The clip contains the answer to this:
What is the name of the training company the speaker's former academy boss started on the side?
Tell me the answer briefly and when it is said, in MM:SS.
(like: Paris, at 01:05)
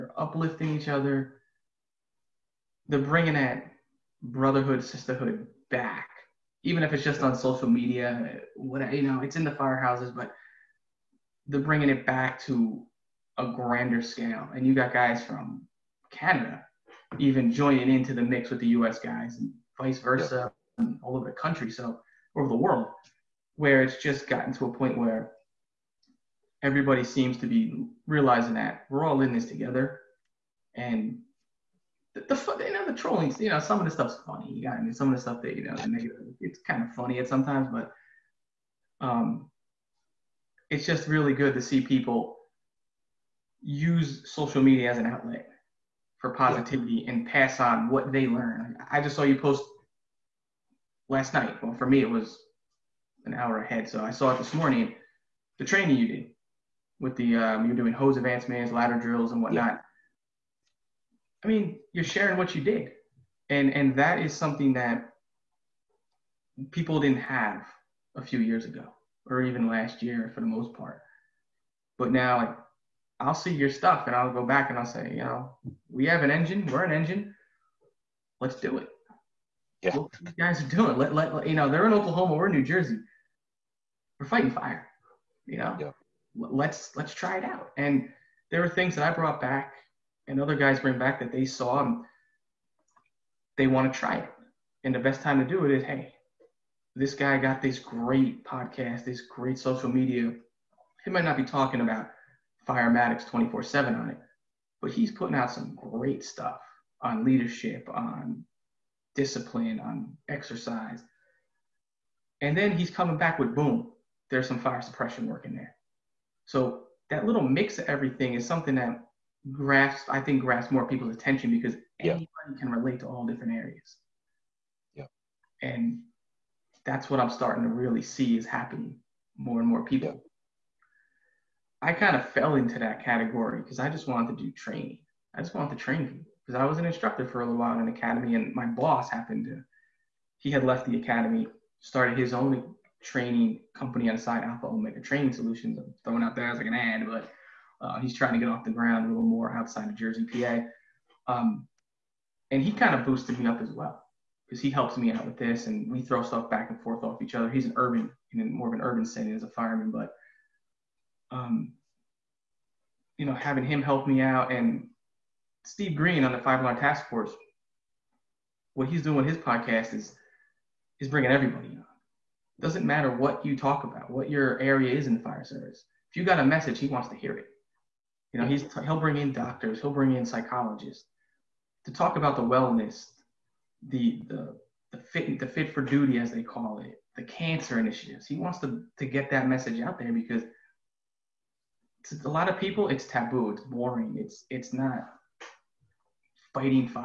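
Alpha Omega Training Solutions, at 02:24.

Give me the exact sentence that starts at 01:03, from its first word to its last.
And and that is something that people didn't have a few years ago or even last year for the most part.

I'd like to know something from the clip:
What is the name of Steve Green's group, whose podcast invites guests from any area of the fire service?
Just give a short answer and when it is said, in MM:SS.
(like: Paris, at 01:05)
Five Alarm Task Force, at 02:46.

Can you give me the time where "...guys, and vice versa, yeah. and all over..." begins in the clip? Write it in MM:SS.
00:18.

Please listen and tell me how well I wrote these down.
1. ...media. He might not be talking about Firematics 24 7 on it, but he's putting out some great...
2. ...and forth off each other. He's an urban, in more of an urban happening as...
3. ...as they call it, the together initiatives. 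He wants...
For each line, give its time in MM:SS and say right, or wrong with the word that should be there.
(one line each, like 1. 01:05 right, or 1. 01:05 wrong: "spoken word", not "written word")
1. 01:39 right
2. 02:36 wrong: "setting", not "happening"
3. 03:06 wrong: "cancer", not "together".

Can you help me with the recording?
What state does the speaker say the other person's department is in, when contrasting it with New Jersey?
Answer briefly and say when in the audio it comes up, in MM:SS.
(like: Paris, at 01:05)
Oklahoma, at 01:21.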